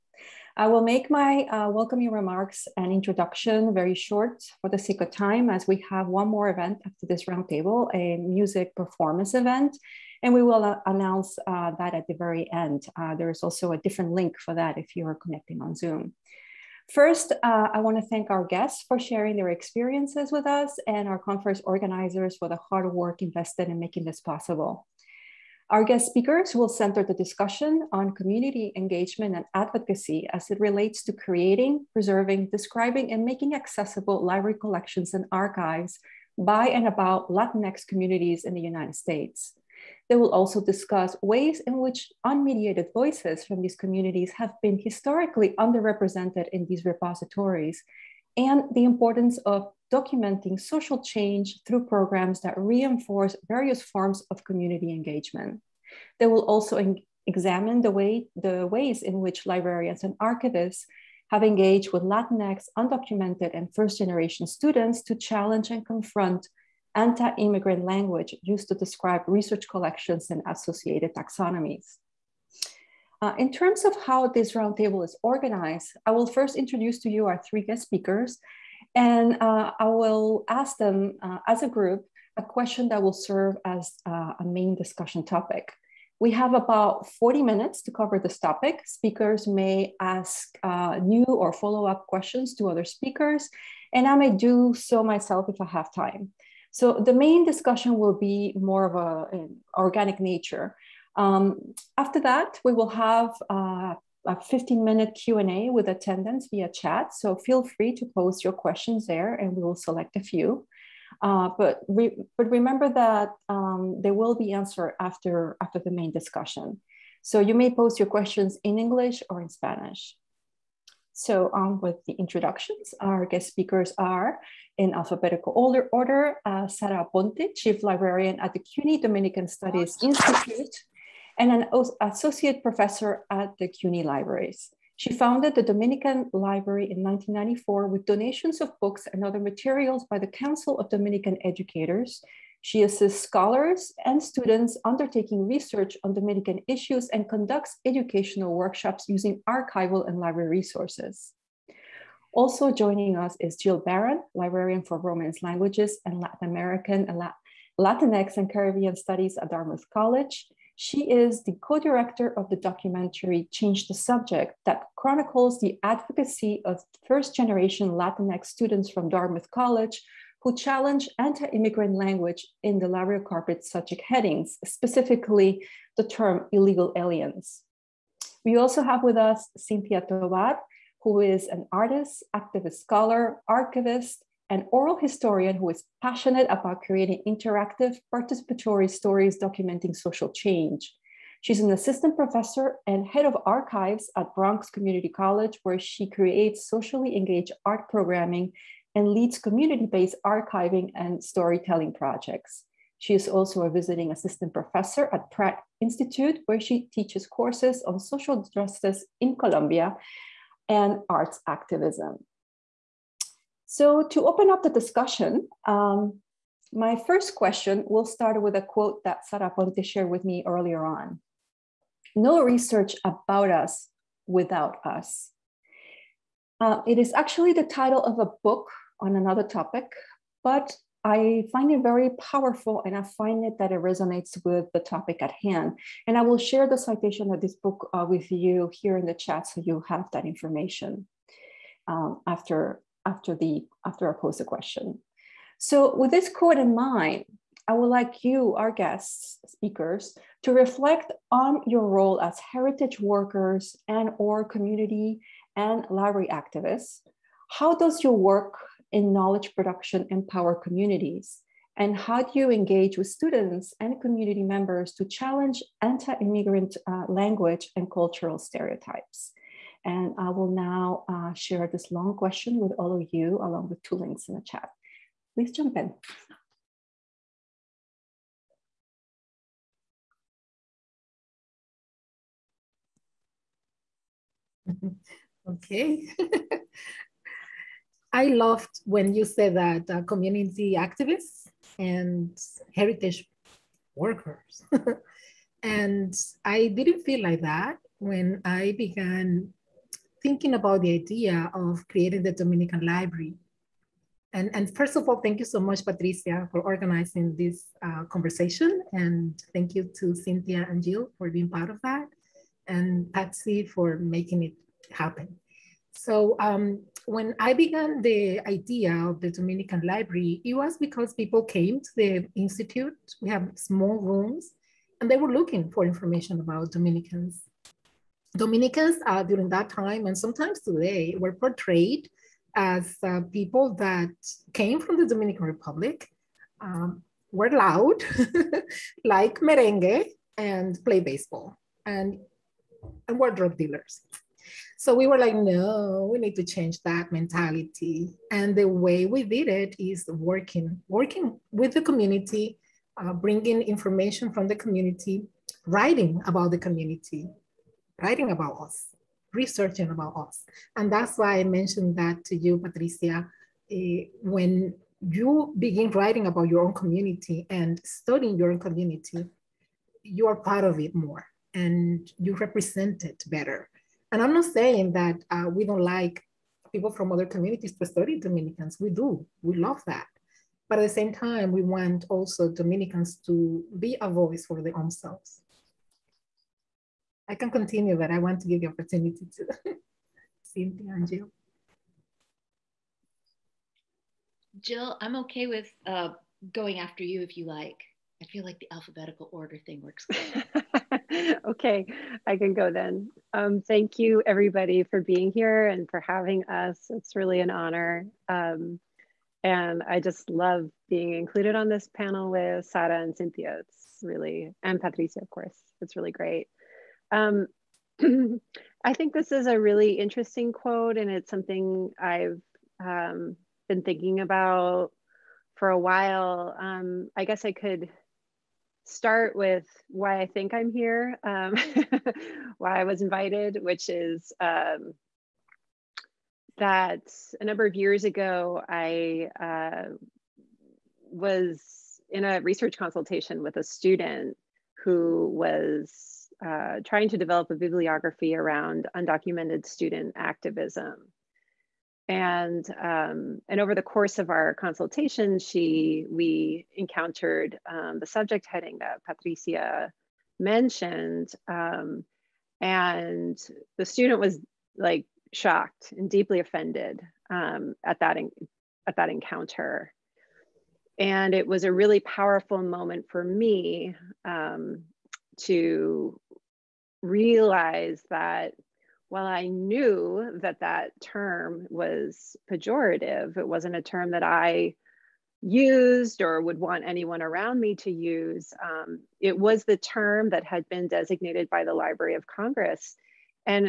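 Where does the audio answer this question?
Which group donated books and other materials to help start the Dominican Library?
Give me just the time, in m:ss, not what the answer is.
2:20.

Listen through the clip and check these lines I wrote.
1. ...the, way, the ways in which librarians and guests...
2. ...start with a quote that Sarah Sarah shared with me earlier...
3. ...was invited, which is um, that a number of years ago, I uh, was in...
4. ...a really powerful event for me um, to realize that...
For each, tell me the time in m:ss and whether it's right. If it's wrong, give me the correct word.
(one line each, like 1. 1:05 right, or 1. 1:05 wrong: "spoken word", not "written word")
1. 0:57 wrong: "archivists", not "guests"
2. 3:38 wrong: "Aponte", not "Sarah"
3. 7:12 right
4. 7:51 wrong: "moment", not "event".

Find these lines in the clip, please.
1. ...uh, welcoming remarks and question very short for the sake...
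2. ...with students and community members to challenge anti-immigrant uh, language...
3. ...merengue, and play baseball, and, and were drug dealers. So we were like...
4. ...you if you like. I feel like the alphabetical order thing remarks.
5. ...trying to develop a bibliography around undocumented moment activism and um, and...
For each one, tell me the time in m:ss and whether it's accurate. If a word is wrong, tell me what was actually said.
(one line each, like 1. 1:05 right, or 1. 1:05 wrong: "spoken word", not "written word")
1. 0:01 wrong: "introduction", not "question"
2. 4:22 right
3. 5:39 right
4. 6:37 wrong: "works", not "remarks"
5. 7:26 wrong: "student", not "moment".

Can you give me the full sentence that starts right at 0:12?
Uh, there is also a different link for that if you are connecting on Zoom.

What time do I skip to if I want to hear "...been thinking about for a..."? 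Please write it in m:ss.
7:03.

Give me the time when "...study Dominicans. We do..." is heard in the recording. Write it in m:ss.
6:17.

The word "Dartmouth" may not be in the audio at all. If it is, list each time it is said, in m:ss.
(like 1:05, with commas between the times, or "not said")
2:39, 2:49.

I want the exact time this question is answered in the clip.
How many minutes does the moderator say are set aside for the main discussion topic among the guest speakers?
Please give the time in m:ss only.
1:27.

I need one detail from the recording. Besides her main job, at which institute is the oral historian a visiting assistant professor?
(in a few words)
Pratt Institute.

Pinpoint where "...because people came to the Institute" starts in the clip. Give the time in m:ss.
5:20.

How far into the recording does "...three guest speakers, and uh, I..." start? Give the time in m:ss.
1:17.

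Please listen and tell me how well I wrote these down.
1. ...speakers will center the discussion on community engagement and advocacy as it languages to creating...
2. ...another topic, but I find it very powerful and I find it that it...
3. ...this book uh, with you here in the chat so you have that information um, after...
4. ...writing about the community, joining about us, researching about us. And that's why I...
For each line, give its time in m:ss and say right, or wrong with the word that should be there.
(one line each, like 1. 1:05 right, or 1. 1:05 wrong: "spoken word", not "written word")
1. 0:26 wrong: "relates", not "languages"
2. 3:49 right
3. 3:57 right
4. 5:55 wrong: "writing", not "joining".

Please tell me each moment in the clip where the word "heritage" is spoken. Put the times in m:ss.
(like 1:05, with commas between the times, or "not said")
4:12, 4:52.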